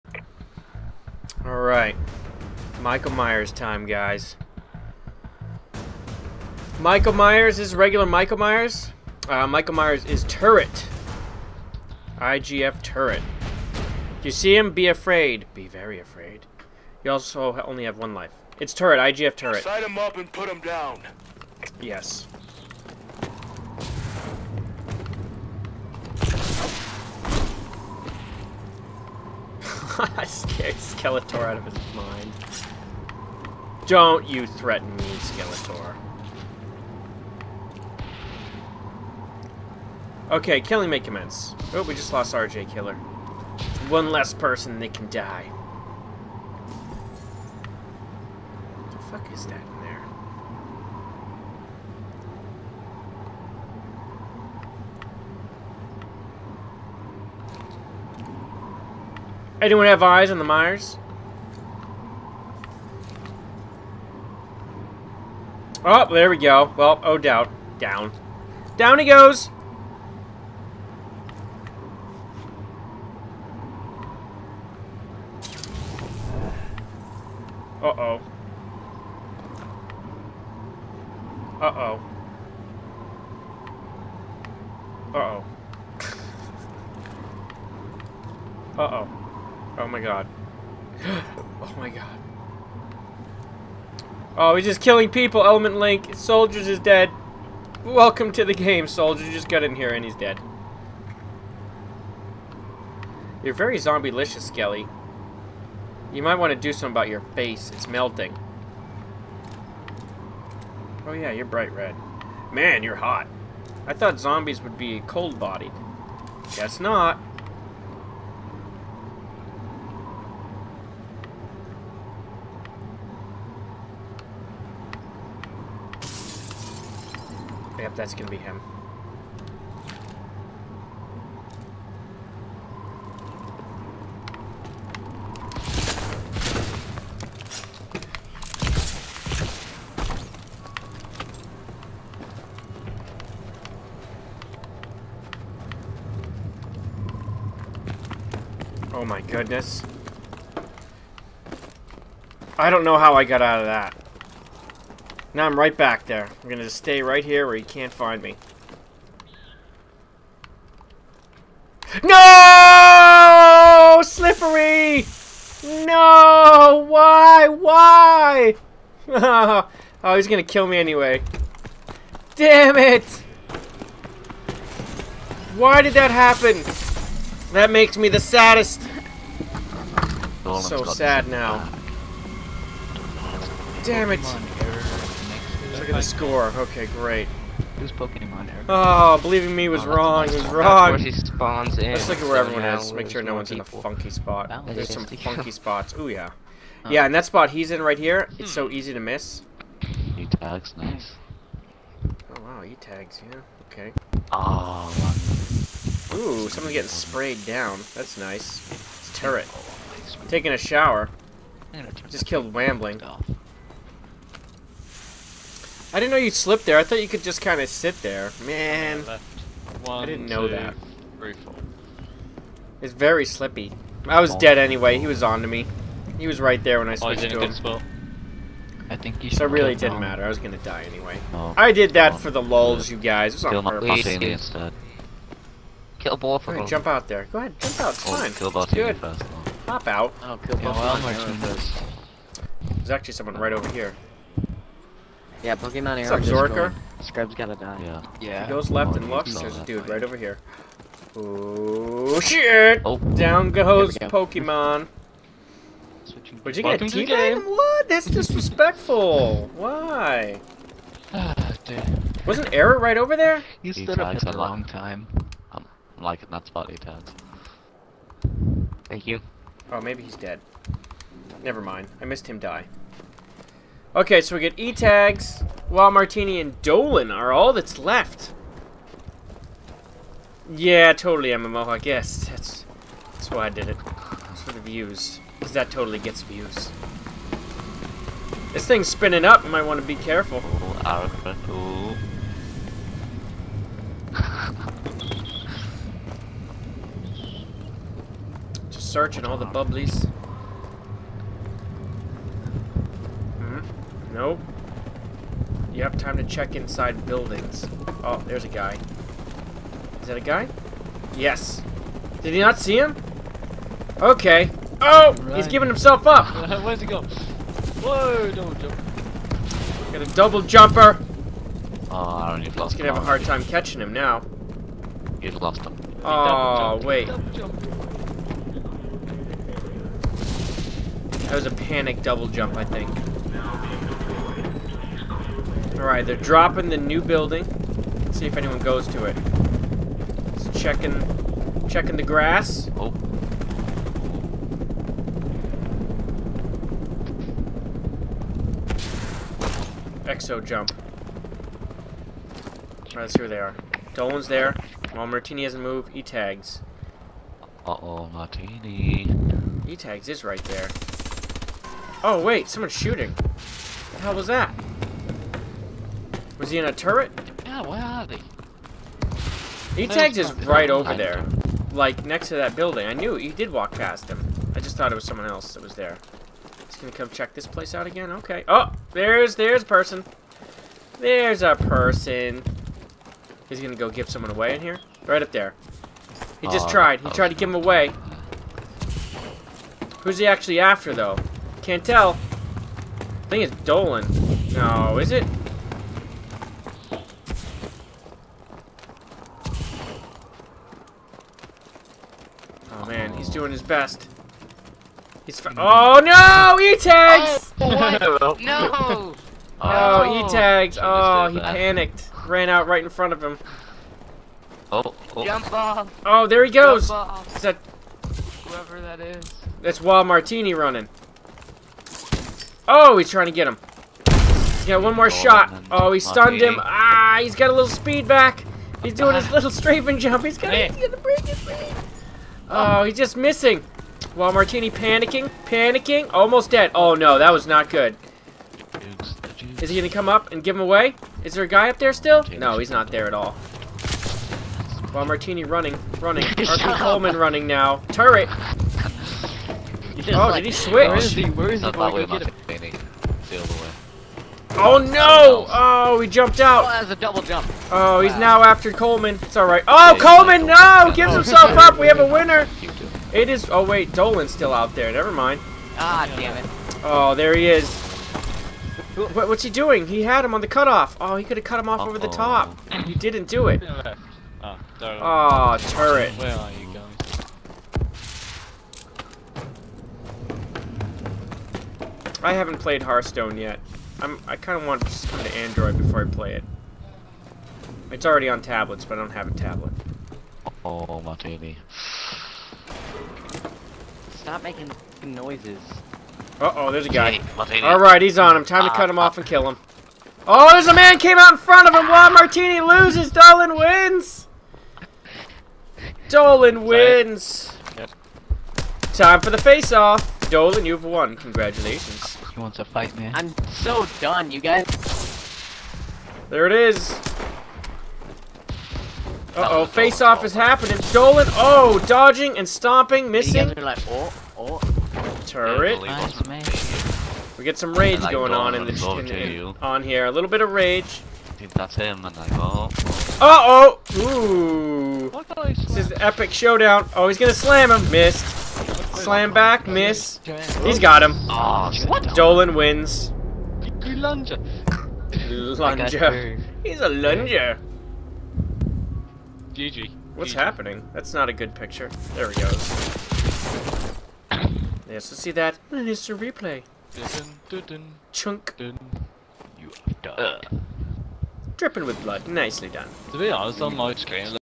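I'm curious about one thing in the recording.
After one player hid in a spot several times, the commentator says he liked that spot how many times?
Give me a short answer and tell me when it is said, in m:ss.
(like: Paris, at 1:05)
8, at 4:26.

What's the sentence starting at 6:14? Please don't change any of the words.
I just thought it was someone else that was there.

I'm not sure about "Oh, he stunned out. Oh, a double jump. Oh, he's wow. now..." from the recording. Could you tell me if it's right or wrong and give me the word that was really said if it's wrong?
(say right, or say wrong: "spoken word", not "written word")
wrong: "jumped", not "stunned".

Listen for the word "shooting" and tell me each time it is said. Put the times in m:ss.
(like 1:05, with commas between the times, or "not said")
6:02.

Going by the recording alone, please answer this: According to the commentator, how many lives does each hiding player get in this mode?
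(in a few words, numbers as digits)
1.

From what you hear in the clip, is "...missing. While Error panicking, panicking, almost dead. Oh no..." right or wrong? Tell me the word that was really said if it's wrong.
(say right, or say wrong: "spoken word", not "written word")
wrong: "Martini", not "Error".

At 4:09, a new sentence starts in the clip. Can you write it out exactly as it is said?
There's a dude right over here.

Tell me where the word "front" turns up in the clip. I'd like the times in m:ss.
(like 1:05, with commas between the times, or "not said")
6:52, 8:21.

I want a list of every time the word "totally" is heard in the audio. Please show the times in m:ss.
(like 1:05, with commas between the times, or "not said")
4:40, 4:45.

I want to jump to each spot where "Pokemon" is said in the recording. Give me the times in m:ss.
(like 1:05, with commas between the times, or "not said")
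3:07, 4:05, 4:14.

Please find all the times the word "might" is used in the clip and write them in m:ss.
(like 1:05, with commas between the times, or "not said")
1:46, 4:49.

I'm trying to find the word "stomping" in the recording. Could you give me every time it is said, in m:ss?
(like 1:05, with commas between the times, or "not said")
8:42.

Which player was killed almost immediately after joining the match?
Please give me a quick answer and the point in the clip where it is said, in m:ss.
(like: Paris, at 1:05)
Soldiers, at 1:36.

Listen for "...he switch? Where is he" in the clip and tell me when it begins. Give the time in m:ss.
7:30.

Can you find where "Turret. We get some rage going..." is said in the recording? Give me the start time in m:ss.
8:45.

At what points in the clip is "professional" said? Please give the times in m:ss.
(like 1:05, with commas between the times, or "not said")
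not said.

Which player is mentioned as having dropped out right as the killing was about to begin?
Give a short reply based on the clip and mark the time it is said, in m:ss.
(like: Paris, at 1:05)
RJ Killer, at 0:42.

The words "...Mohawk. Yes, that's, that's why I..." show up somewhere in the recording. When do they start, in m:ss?
4:41.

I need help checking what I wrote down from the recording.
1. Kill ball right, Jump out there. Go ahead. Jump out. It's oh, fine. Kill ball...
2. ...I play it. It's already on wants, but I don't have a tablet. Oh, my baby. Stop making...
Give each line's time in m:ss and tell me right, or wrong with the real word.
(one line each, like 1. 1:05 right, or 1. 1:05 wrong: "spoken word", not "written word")
1. 3:55 right
2. 8:06 wrong: "tablets", not "wants".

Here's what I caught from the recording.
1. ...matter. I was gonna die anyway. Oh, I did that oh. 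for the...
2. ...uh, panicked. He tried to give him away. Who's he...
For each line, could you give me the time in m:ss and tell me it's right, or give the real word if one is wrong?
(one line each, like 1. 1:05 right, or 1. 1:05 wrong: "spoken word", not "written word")
1. 3:49 right
2. 6:26 wrong: "tried", not "panicked".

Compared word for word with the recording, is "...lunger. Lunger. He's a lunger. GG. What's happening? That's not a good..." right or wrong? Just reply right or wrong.
right.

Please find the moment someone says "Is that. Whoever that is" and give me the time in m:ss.
6:56.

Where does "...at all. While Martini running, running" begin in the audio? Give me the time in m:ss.
7:23.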